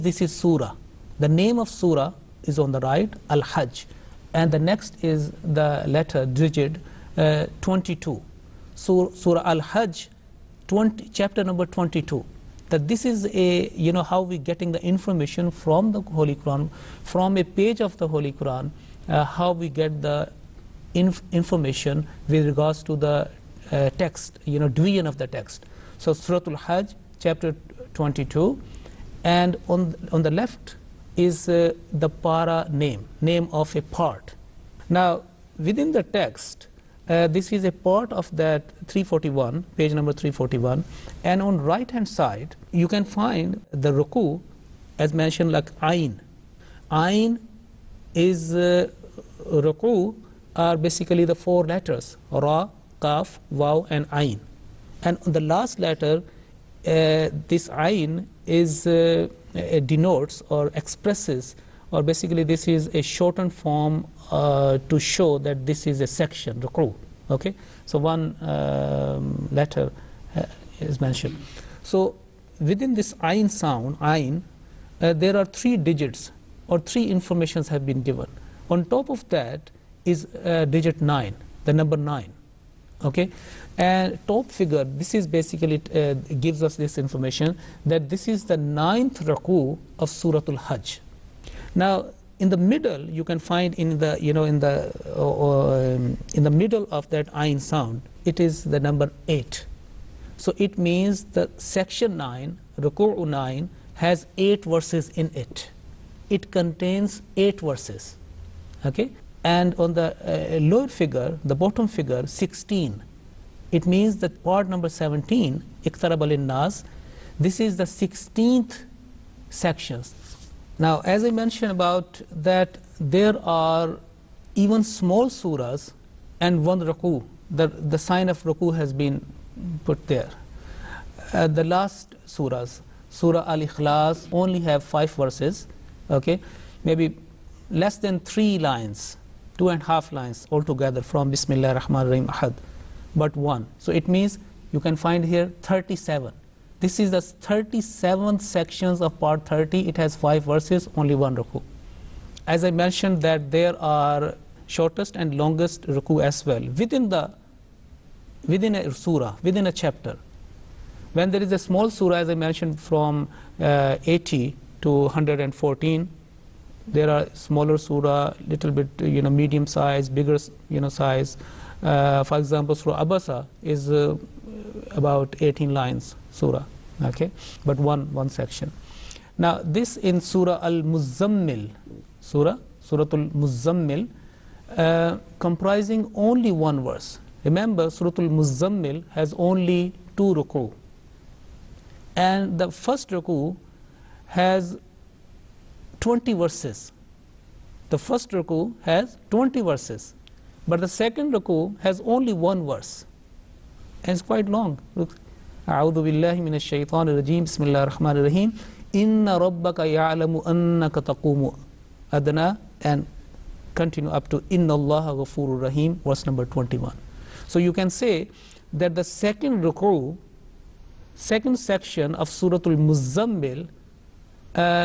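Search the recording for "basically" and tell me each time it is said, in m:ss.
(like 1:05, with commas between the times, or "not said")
0:50, 1:02, 1:25.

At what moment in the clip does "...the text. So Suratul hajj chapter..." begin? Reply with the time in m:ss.
0:25.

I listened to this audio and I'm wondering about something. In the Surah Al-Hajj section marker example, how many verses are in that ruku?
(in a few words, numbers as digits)
8.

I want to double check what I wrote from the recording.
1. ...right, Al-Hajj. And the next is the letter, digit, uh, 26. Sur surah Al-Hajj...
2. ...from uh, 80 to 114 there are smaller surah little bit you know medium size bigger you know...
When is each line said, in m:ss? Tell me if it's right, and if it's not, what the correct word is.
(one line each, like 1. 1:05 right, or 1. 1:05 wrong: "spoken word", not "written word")
1. 0:02 wrong: "22", not "26"
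2. 2:42 right.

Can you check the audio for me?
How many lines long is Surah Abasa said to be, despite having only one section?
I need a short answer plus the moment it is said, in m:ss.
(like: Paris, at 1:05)
18, at 2:55.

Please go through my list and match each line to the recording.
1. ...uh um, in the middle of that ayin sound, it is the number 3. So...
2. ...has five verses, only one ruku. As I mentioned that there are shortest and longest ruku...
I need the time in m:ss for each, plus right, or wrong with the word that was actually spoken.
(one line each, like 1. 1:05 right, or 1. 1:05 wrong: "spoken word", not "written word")
1. 1:35 wrong: "8", not "3"
2. 2:29 right.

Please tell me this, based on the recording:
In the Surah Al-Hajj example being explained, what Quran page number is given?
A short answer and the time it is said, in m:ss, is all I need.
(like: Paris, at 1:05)
341, at 0:39.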